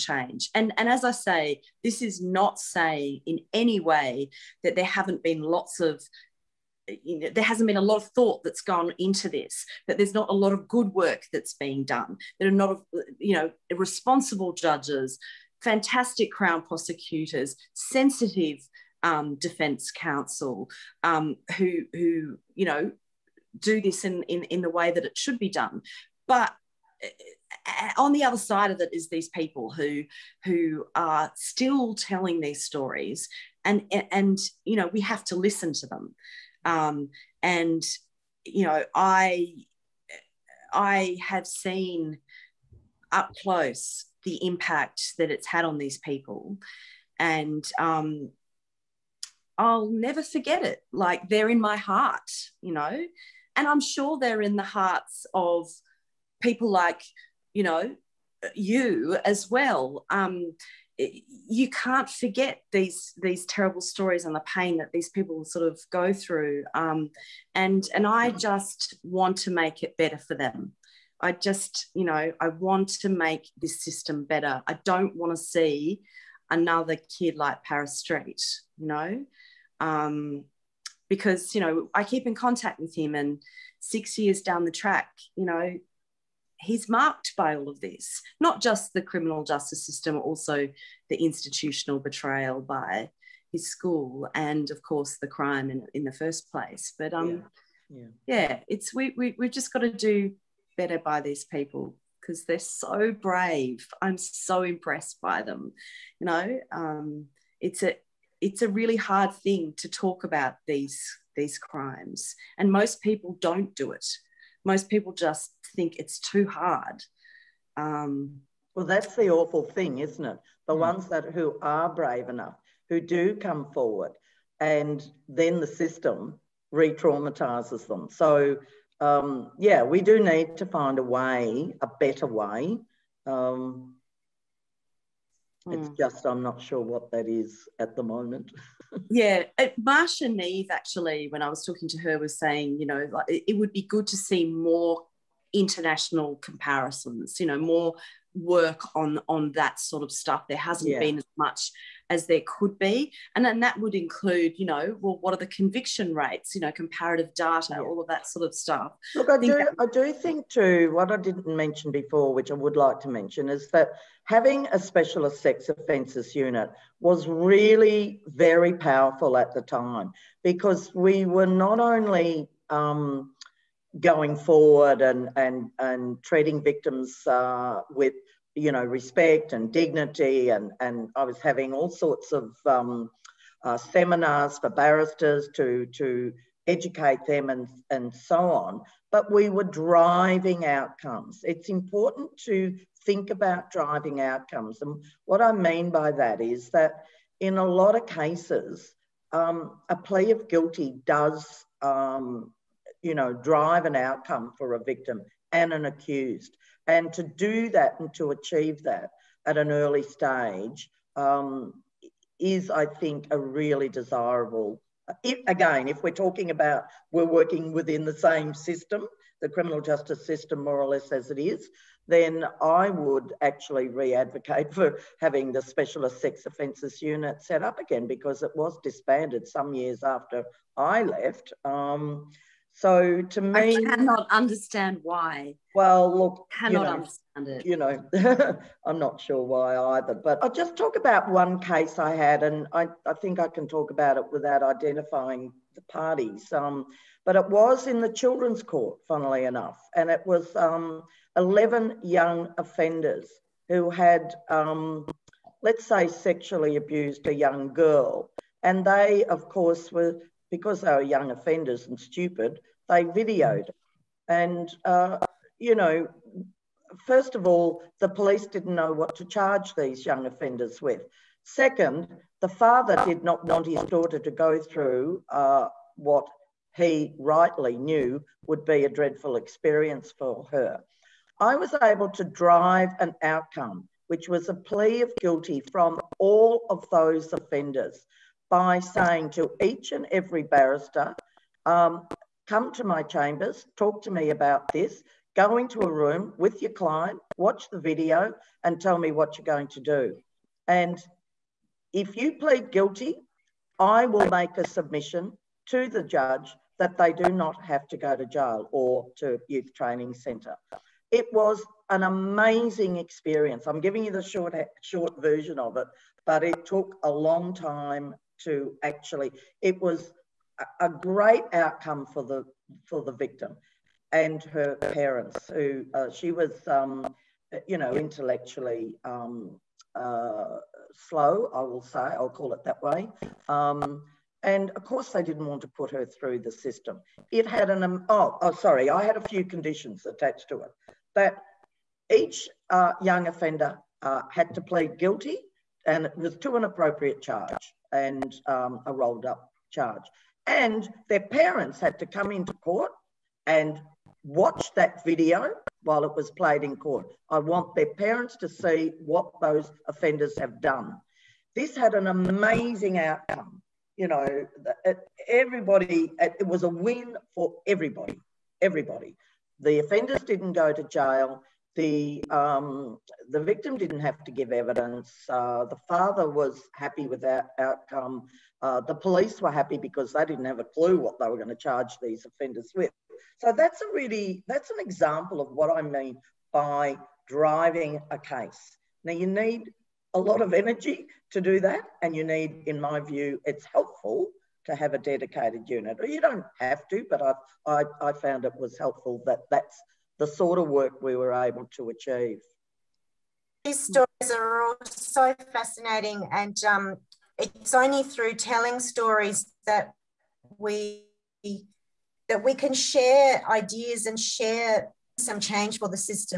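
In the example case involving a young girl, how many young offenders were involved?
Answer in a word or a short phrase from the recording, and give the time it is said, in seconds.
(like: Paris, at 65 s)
11, at 251 s.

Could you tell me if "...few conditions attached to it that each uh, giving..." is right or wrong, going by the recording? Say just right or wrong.
wrong.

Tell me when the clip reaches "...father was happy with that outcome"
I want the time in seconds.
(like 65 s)
375 s.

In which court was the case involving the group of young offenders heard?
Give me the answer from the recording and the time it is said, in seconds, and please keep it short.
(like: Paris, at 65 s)
Children's court, at 248 s.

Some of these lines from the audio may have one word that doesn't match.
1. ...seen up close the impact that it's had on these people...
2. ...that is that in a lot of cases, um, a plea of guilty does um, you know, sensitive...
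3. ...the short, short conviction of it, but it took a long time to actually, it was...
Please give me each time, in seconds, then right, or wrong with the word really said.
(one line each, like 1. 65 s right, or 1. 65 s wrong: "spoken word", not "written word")
1. 41 s right
2. 196 s wrong: "drive", not "sensitive"
3. 314 s wrong: "version", not "conviction".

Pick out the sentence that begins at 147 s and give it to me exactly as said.
You know, more work on on that sort of stuff there hasn't yeah.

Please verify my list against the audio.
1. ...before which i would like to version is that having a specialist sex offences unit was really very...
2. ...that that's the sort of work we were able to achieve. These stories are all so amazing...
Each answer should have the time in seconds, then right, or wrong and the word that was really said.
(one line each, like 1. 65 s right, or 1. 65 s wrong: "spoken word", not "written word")
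1. 161 s wrong: "mention", not "version"
2. 399 s wrong: "fascinating", not "amazing".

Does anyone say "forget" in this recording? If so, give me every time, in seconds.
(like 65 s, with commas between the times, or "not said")
50 s, 62 s.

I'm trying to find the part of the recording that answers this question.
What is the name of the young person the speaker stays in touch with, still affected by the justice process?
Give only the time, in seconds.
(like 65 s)
77 s.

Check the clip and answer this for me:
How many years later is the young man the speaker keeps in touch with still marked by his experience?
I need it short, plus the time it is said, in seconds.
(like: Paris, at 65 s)
6, at 83 s.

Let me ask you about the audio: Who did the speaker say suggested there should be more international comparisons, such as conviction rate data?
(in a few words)
Marcia Neave.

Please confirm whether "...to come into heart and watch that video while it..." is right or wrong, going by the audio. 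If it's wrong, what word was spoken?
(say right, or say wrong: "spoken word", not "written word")
wrong: "court", not "heart".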